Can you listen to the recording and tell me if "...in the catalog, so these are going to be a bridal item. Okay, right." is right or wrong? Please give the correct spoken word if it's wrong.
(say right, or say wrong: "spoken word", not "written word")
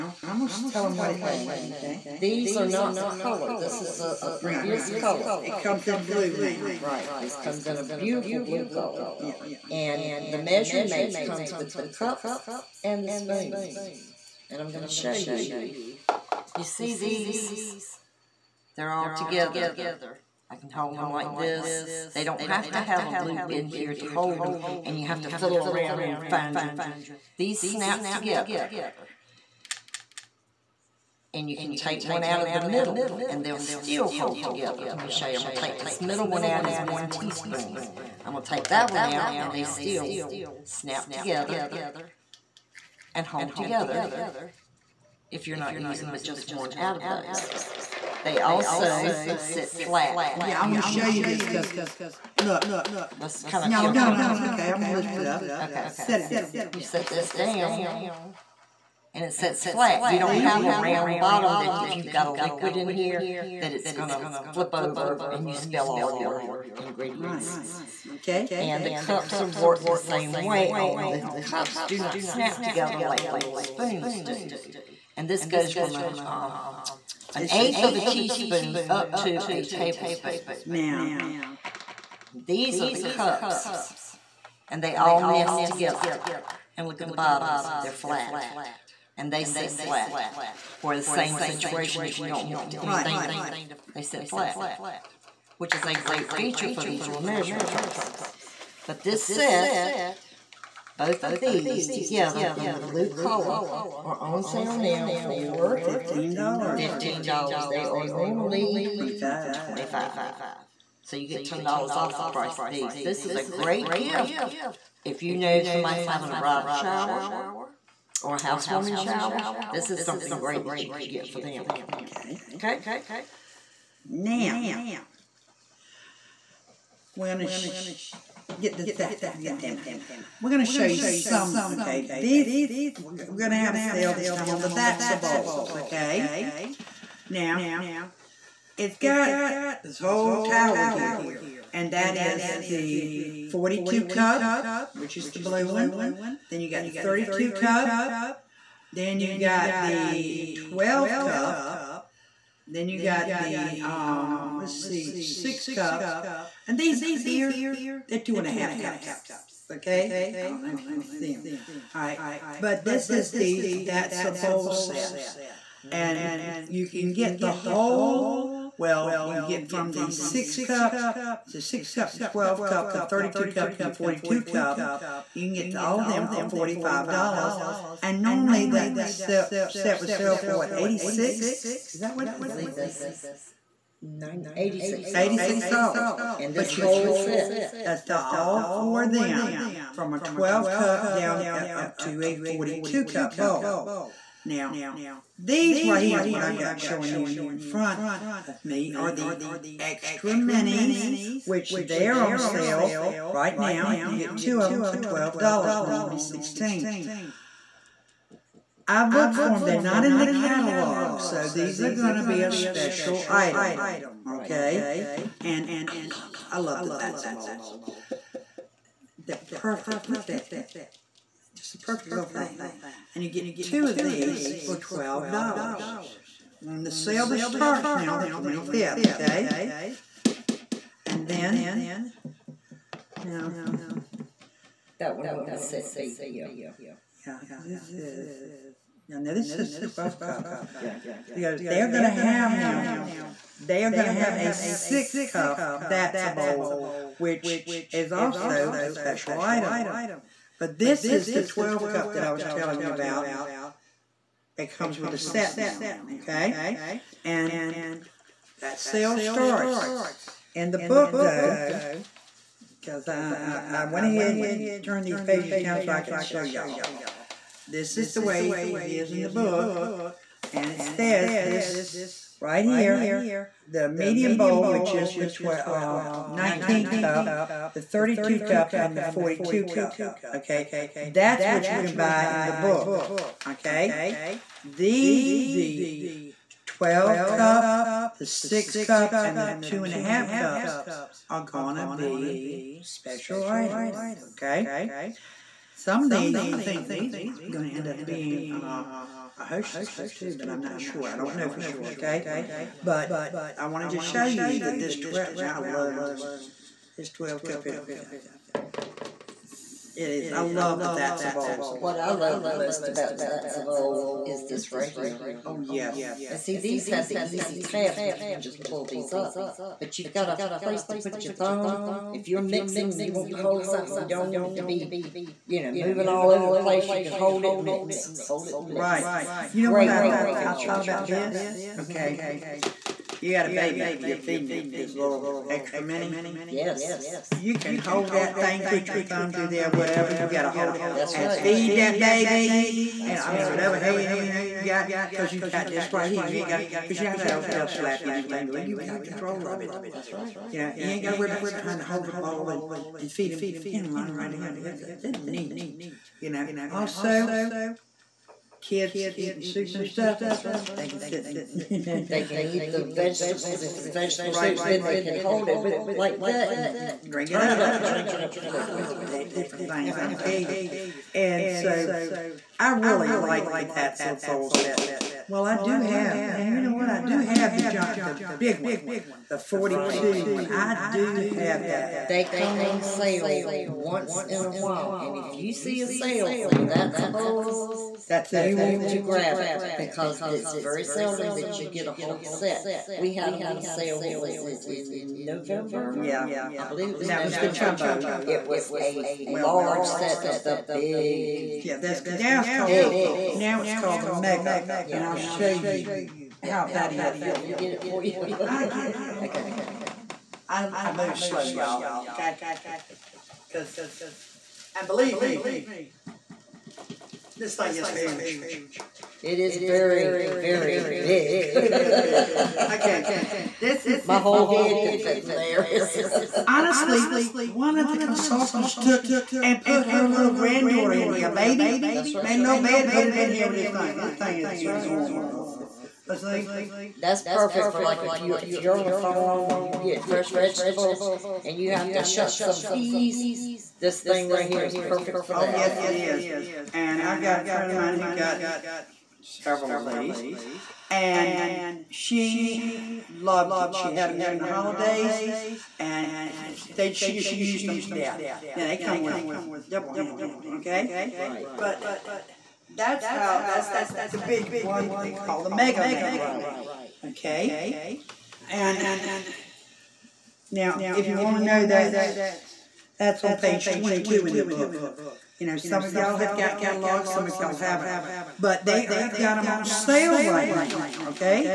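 wrong: "special", not "bridal".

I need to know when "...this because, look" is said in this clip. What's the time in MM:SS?
00:51.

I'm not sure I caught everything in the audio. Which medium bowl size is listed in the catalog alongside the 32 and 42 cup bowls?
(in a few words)
19 cup.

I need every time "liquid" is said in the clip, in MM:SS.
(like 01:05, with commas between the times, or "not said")
01:02.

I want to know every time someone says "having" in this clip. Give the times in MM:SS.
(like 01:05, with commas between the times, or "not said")
01:56.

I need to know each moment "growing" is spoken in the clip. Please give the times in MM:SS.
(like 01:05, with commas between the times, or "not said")
not said.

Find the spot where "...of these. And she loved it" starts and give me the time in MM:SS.
07:29.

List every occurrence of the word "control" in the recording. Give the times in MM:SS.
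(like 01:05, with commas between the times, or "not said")
05:49.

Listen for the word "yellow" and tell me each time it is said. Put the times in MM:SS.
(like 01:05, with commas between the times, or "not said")
not said.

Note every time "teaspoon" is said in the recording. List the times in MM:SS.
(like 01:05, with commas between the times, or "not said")
00:37, 01:18.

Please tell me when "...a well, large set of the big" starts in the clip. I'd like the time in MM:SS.
06:38.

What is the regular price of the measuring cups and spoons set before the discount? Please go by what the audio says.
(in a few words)
$25.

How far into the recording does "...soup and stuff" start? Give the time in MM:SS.
05:59.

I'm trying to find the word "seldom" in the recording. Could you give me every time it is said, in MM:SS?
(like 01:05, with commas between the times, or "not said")
06:30.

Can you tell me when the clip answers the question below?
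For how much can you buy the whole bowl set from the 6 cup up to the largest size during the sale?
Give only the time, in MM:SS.
02:56.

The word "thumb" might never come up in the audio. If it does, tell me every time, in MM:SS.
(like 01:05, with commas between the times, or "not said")
05:21, 05:39.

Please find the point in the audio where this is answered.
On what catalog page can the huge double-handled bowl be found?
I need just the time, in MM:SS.
07:53.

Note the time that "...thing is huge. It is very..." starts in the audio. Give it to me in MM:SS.
06:57.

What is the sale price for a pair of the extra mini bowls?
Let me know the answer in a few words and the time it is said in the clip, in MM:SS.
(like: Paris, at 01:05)
$12, at 03:24.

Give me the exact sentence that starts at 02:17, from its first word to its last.
Now, it's got this whole tower here, and that is the 42 cup, which is the blue one.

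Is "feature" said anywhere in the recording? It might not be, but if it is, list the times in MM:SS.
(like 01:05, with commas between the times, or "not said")
01:36, 05:30.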